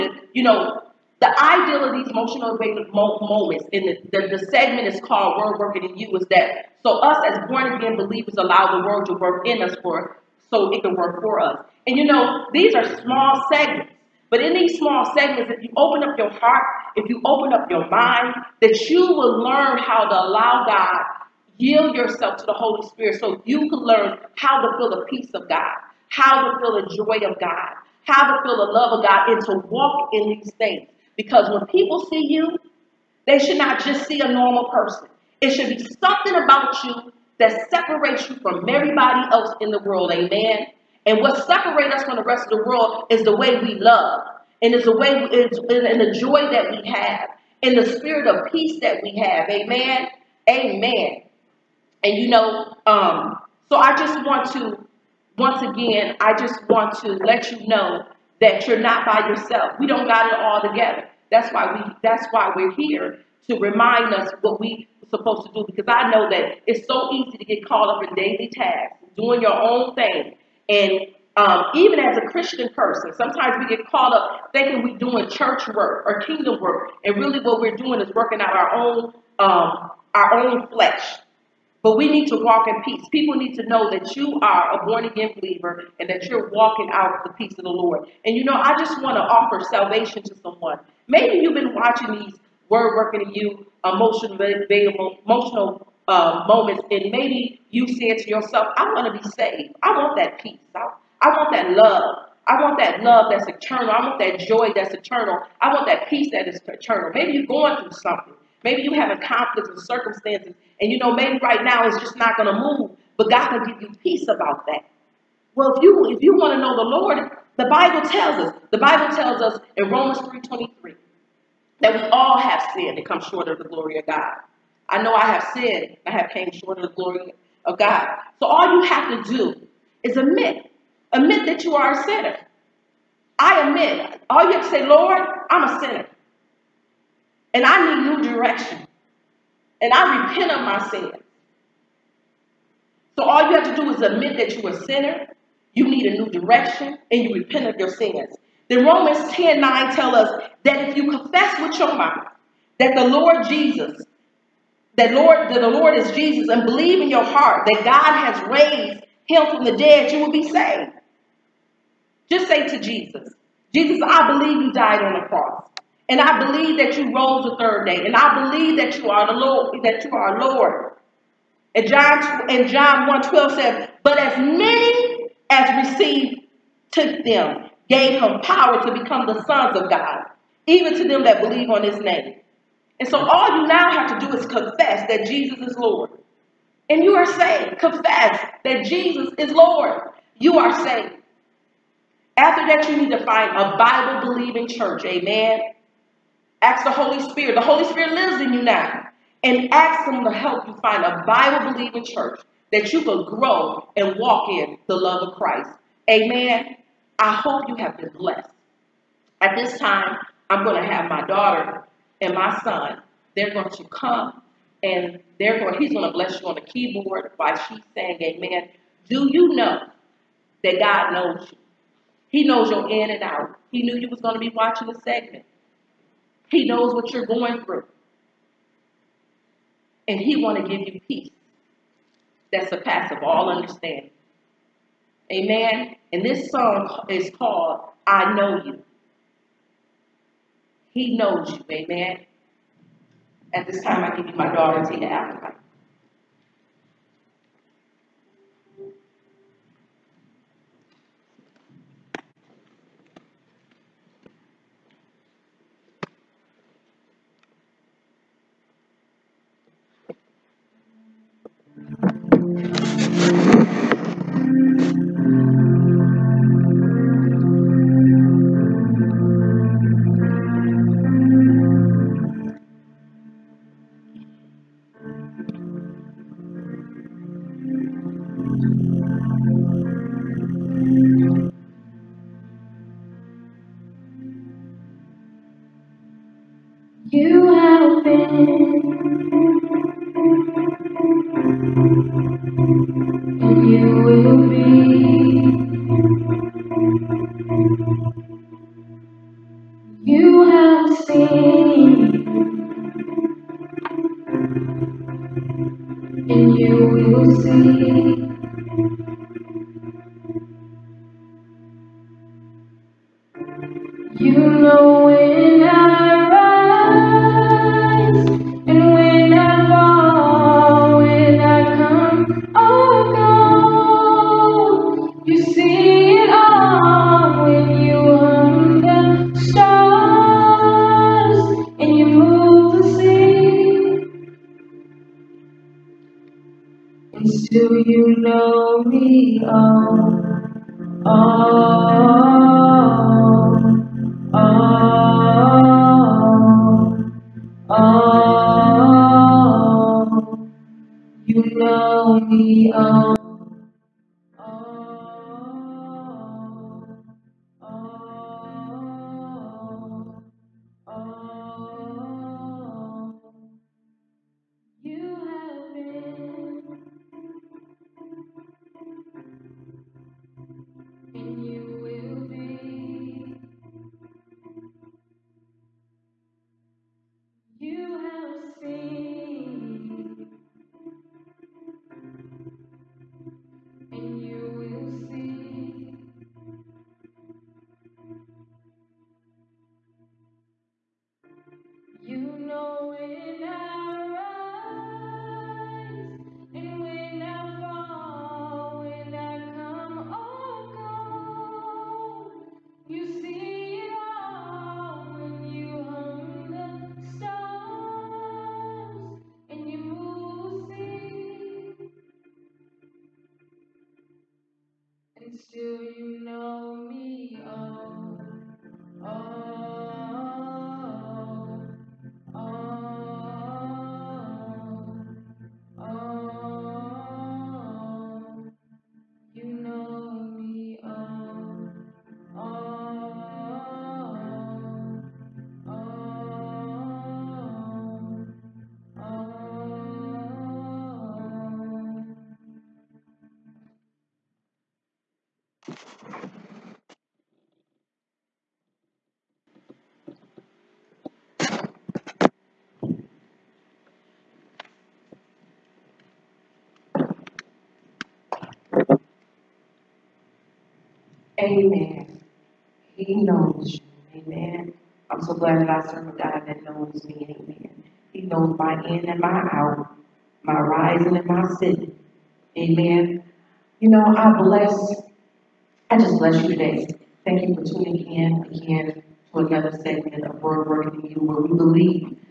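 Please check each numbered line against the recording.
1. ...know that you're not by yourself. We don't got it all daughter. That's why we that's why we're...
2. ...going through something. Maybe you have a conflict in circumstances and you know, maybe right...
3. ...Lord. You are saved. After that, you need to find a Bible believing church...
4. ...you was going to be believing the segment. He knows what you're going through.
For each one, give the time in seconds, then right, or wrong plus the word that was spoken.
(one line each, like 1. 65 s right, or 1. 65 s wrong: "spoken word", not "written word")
1. 57 s wrong: "together", not "daughter"
2. 107 s right
3. 189 s right
4. 223 s wrong: "watching", not "believing".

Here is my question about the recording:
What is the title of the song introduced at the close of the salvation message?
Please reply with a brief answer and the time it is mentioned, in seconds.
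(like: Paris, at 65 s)
I Know You, at 238 s.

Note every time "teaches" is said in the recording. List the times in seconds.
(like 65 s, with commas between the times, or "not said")
not said.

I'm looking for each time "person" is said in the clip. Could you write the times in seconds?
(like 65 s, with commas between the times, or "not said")
34 s, 72 s.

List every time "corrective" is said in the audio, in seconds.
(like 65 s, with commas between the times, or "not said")
not said.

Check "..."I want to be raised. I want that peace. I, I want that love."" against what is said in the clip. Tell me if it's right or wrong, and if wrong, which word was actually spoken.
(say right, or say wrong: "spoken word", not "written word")
wrong: "saved", not "raised".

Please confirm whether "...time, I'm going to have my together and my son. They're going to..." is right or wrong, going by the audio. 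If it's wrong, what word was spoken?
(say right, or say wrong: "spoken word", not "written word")
wrong: "daughter", not "together".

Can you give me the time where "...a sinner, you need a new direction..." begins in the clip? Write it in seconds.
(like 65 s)
144 s.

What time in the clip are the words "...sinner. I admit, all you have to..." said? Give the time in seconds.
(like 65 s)
132 s.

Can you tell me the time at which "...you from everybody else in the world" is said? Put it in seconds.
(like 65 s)
38 s.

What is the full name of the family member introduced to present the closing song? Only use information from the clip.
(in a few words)
Tina Applewhite.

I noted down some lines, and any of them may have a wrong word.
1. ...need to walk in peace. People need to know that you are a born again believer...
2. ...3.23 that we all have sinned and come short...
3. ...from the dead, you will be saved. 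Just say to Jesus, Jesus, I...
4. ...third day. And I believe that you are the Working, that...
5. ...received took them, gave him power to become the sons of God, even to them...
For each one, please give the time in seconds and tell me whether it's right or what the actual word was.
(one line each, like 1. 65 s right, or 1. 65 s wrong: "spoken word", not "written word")
1. 82 s right
2. 120 s right
3. 159 s right
4. 167 s wrong: "Lord", not "Working"
5. 175 s right.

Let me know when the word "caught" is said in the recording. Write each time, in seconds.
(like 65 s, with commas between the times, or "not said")
67 s, 73 s.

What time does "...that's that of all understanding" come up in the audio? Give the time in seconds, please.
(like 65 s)
232 s.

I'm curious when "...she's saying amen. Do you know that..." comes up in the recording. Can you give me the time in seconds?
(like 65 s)
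217 s.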